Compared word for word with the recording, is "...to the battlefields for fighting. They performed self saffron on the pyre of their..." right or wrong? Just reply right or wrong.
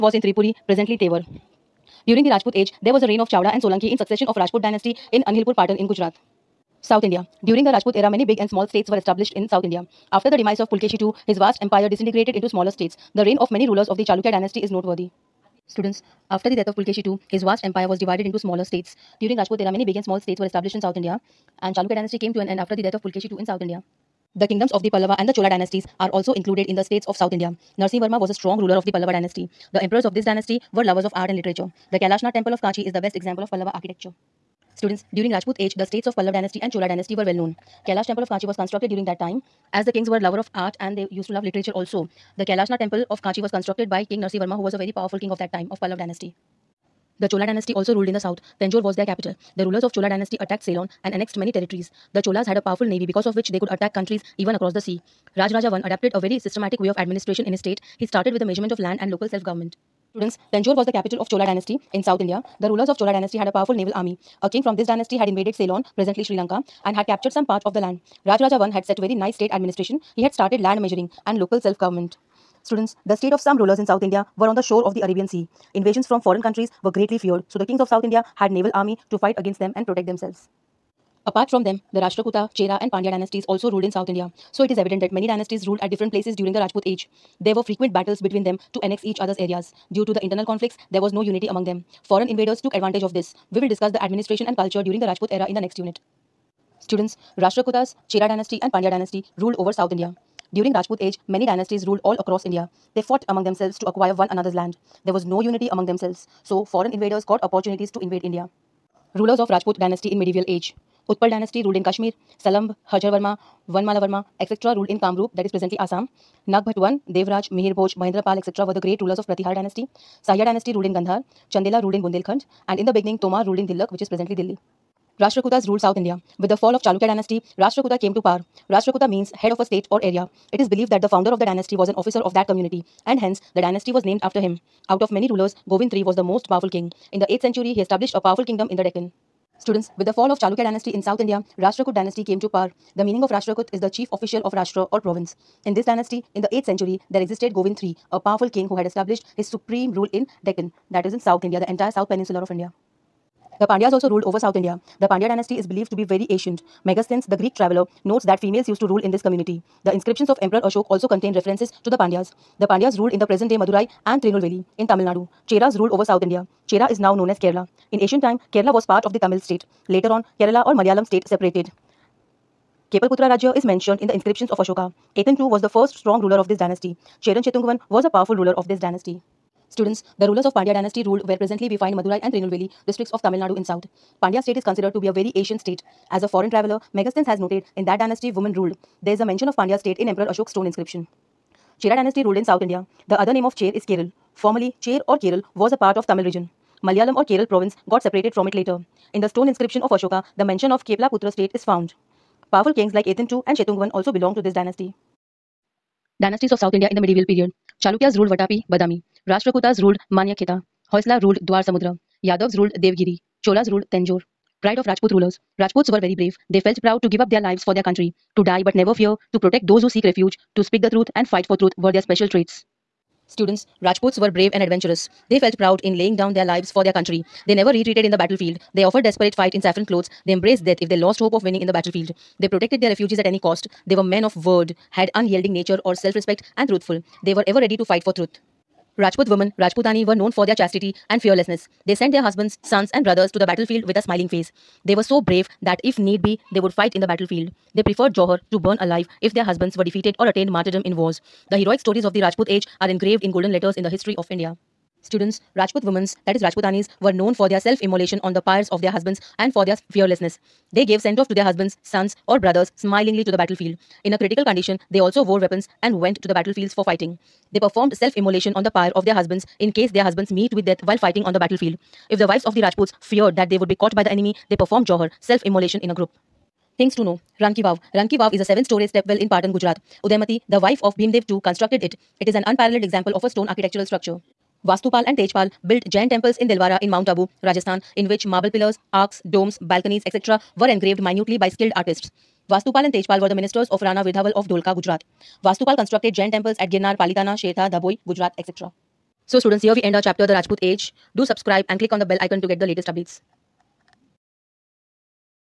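wrong.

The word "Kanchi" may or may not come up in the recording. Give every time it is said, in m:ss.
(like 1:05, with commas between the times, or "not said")
0:32, 0:38, 0:43.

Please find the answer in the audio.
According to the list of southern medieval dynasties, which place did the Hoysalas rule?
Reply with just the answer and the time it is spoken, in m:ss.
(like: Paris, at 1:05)
Dwar Samudra, at 3:31.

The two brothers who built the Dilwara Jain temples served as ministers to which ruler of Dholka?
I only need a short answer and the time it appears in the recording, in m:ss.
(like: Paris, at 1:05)
Rana Virdhaval, at 4:53.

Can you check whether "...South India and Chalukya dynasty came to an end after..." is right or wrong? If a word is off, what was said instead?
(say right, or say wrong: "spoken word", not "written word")
right.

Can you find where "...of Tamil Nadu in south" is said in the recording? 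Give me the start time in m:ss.
3:03.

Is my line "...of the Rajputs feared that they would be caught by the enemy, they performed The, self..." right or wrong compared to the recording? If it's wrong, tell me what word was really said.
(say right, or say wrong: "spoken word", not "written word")
wrong: "Jauhar", not "The".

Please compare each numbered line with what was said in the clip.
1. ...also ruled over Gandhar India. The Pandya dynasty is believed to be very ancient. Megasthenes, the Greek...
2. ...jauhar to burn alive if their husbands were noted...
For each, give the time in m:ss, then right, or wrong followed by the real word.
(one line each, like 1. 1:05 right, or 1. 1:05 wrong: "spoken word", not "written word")
1. 2:33 wrong: "South", not "Gandhar"
2. 4:08 wrong: "defeated", not "noted".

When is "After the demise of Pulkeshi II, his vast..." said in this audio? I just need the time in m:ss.
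0:10.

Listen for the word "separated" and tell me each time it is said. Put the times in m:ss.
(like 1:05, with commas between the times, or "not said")
2:51, 3:18.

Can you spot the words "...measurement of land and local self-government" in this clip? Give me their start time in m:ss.
0:58.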